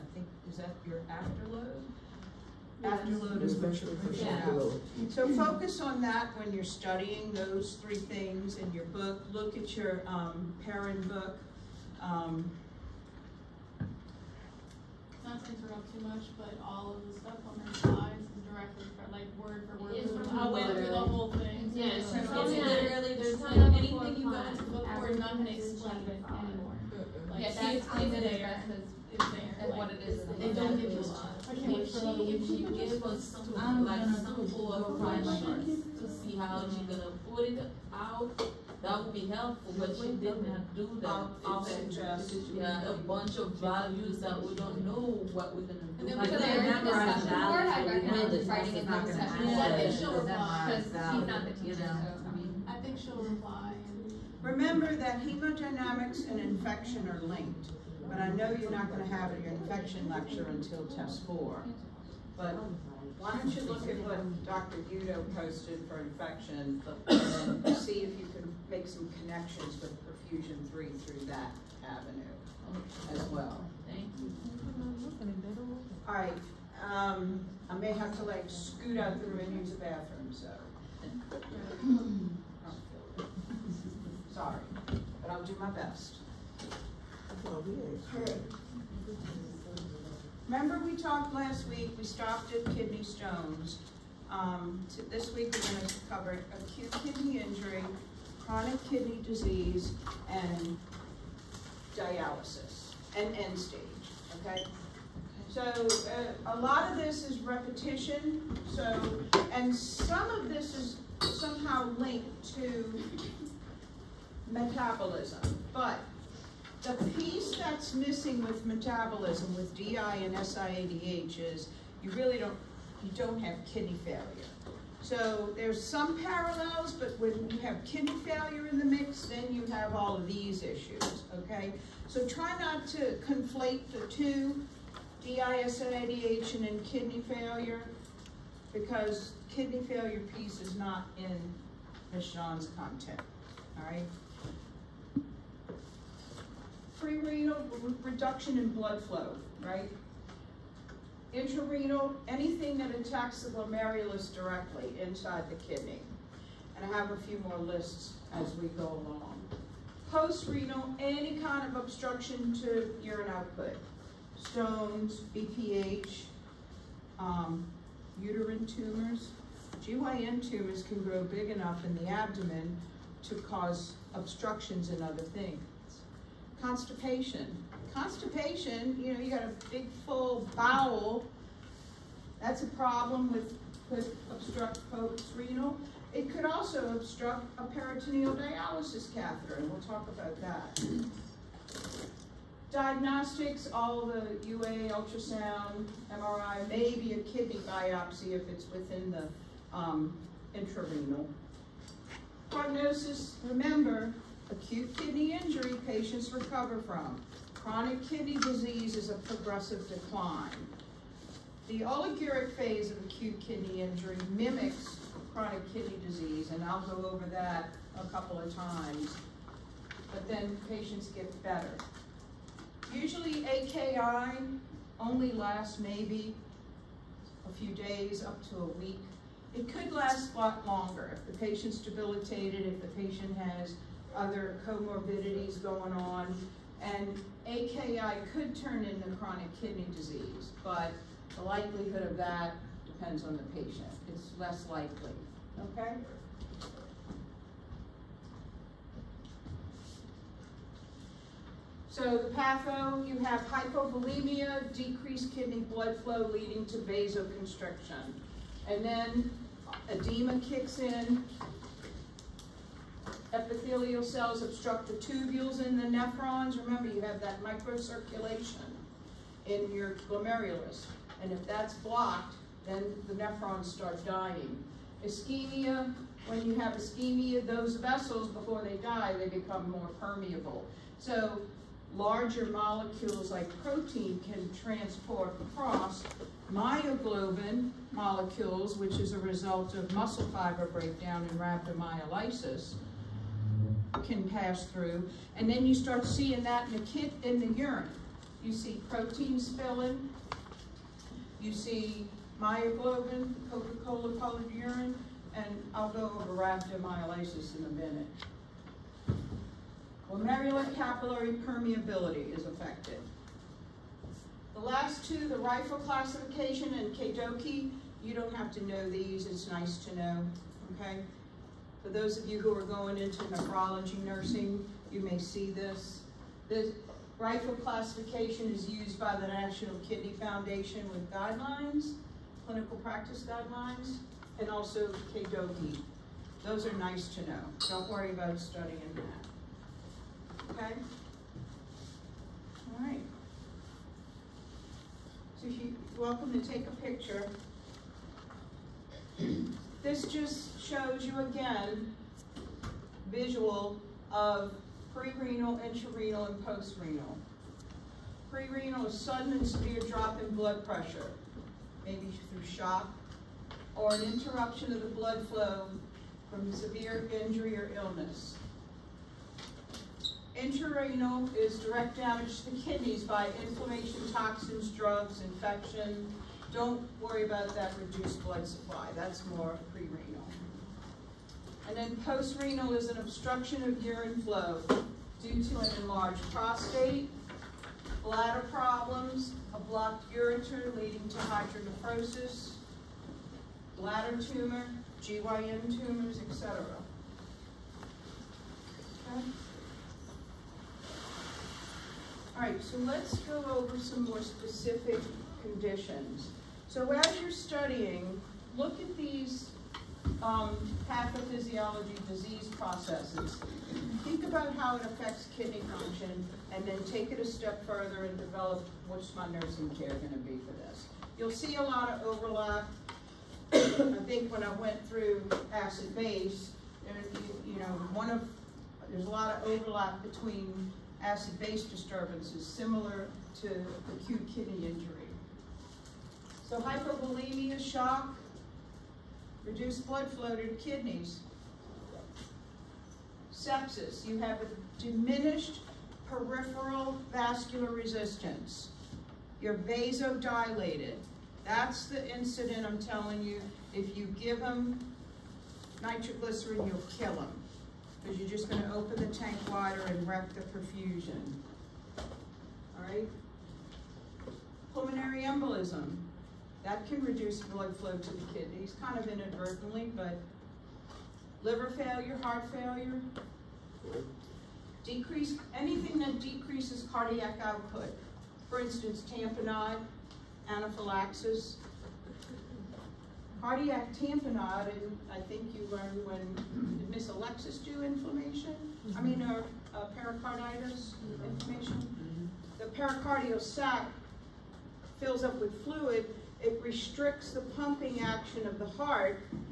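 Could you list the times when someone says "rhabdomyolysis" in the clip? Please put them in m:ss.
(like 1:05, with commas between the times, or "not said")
4:51, 5:06.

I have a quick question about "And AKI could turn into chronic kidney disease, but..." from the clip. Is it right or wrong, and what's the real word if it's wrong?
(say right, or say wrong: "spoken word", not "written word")
right.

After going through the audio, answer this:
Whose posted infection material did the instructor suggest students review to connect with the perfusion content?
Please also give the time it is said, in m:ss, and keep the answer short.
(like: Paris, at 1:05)
Dr. Udo, at 1:04.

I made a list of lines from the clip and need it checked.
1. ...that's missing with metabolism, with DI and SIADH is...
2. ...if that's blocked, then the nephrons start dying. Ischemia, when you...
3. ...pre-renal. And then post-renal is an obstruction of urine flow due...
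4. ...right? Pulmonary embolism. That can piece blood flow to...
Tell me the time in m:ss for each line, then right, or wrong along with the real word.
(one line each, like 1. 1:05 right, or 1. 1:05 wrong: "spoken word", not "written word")
1. 1:57 right
2. 4:31 right
3. 6:19 right
4. 7:42 wrong: "reduce", not "piece".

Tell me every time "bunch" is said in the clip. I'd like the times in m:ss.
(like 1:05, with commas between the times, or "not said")
0:42.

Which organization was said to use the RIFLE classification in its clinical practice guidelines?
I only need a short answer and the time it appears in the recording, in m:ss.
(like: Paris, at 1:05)
National Kidney Foundation, at 5:29.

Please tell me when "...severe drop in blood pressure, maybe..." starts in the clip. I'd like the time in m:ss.
5:59.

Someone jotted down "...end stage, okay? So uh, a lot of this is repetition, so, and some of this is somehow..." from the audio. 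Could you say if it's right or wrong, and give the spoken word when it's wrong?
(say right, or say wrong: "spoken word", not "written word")
right.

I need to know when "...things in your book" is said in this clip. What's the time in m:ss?
0:07.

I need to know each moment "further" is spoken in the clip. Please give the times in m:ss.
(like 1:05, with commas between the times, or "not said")
6:57.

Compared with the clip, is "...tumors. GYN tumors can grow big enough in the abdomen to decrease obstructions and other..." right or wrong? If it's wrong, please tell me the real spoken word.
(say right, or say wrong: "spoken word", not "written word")
wrong: "cause", not "decrease".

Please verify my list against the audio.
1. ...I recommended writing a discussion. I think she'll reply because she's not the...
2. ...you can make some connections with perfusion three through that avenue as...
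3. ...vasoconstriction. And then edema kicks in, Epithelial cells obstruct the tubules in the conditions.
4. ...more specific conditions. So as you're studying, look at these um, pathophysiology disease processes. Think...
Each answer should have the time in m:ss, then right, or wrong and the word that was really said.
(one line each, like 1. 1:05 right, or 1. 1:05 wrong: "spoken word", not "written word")
1. 0:47 right
2. 1:08 right
3. 4:16 wrong: "nephrons", not "conditions"
4. 6:44 right.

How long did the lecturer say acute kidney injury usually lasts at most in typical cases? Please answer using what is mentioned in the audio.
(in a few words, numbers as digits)
up to a week.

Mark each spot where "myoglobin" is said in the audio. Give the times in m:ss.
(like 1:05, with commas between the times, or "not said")
4:46, 5:02.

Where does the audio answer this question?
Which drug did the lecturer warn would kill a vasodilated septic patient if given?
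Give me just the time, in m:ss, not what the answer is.
7:35.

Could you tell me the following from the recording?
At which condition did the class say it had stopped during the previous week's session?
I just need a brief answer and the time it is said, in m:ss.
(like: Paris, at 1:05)
kidney stones, at 1:32.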